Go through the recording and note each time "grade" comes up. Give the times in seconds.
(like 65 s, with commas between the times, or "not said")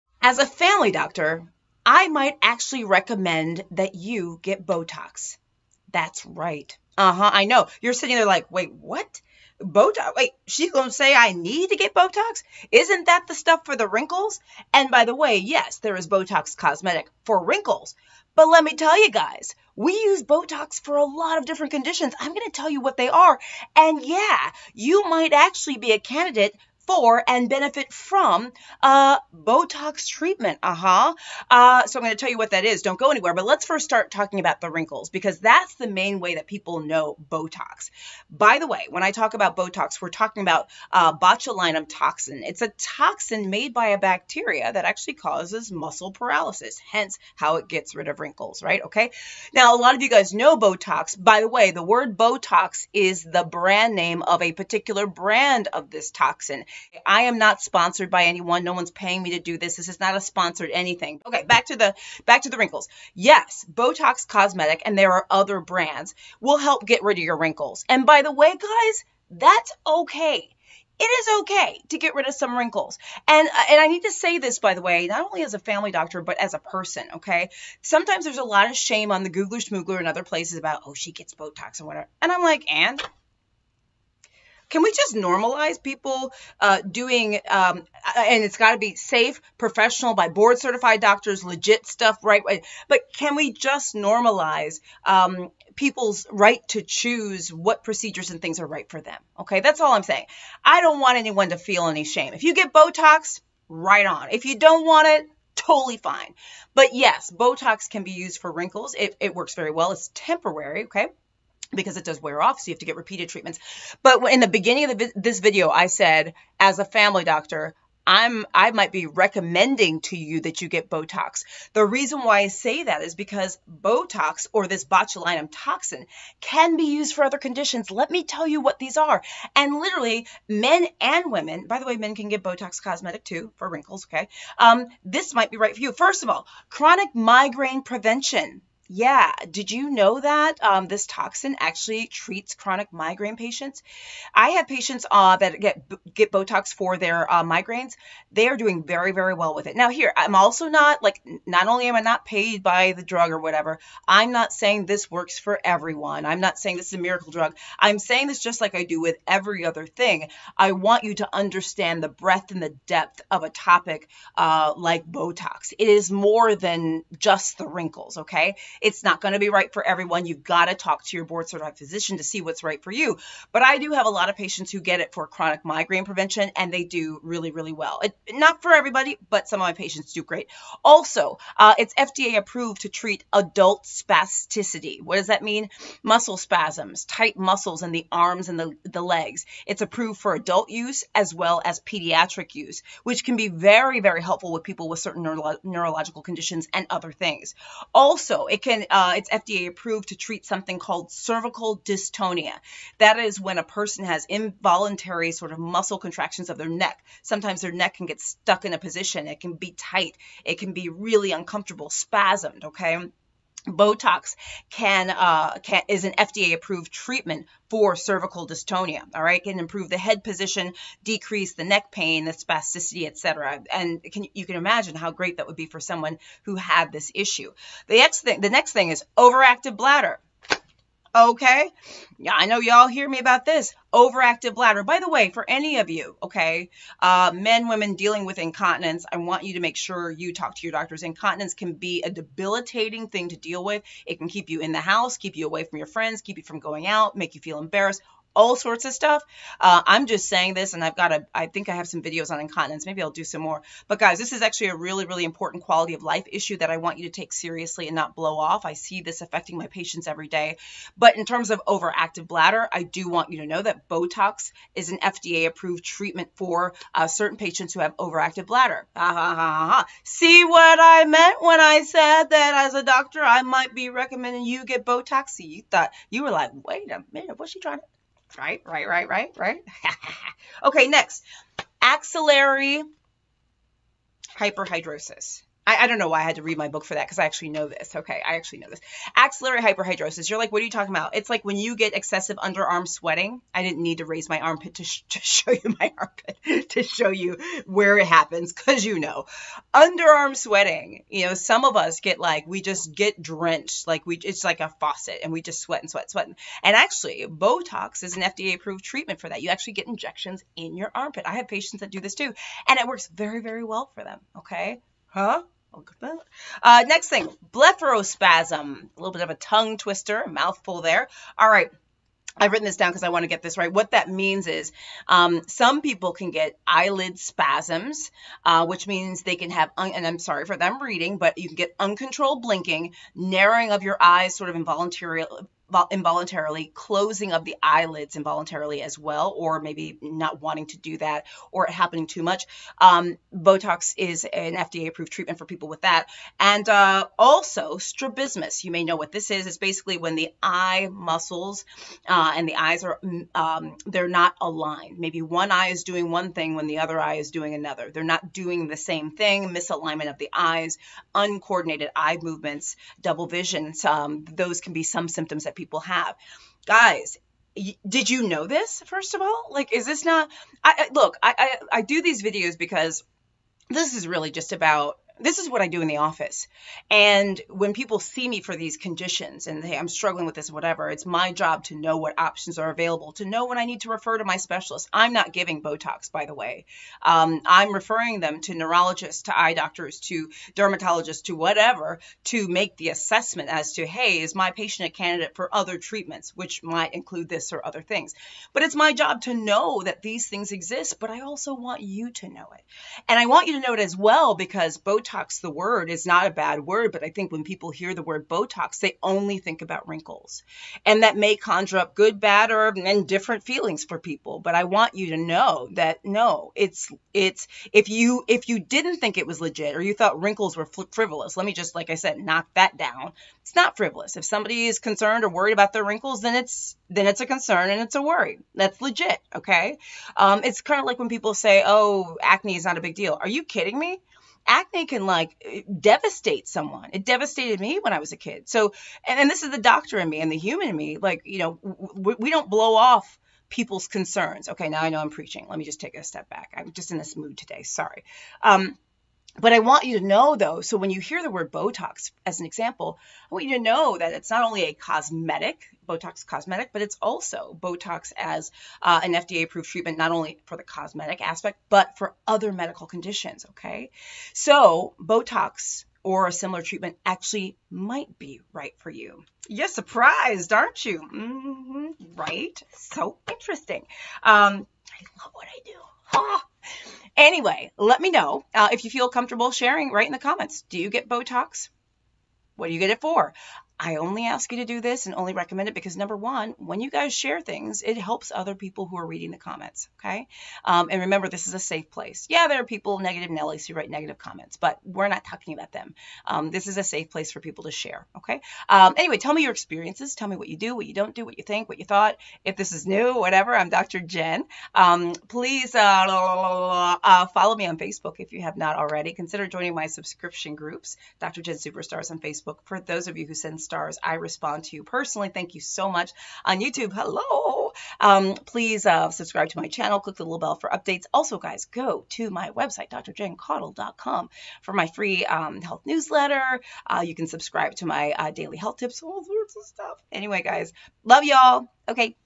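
not said.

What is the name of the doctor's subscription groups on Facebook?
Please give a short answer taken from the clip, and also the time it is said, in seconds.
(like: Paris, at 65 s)
Dr. Jen Superstars, at 511 s.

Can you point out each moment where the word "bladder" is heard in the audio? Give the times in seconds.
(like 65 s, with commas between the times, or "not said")
229 s, 234 s, 262 s, 268 s.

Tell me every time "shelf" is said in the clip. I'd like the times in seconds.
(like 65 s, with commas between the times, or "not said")
not said.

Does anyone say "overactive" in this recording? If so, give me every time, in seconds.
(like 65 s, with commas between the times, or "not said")
229 s, 233 s, 261 s, 267 s.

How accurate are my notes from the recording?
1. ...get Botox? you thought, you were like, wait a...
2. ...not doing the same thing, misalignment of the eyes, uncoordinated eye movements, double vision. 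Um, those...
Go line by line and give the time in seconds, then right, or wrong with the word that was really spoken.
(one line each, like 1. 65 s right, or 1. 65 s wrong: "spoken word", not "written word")
1. 274 s right
2. 358 s right.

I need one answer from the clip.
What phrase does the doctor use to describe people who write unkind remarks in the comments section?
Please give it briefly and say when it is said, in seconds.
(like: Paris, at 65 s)
negative Nellies, at 492 s.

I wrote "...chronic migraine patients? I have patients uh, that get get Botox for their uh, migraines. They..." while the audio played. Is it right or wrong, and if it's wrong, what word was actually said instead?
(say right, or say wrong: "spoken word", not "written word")
right.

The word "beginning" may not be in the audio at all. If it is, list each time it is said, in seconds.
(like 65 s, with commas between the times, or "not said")
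114 s.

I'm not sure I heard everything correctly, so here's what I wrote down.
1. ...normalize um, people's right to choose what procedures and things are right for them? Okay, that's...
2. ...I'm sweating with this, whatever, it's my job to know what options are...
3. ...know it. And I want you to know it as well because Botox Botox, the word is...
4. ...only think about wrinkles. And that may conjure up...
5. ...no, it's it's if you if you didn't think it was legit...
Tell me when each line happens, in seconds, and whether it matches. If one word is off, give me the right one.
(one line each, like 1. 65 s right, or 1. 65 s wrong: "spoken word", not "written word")
1. 93 s right
2. 379 s wrong: "struggling", not "sweating"
3. 402 s right
4. 409 s right
5. 416 s right.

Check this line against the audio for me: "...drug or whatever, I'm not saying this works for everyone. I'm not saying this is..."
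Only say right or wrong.
right.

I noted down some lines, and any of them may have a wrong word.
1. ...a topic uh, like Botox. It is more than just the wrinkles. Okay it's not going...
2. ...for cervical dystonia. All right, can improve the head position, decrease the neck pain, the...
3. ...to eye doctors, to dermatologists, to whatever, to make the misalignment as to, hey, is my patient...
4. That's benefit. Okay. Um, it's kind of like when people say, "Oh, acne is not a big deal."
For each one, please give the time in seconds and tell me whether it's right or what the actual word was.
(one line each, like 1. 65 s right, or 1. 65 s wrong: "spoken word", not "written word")
1. 163 s right
2. 217 s right
3. 389 s wrong: "assessment", not "misalignment"
4. 428 s wrong: "legit", not "benefit".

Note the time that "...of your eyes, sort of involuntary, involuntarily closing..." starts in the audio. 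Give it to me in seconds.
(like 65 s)
333 s.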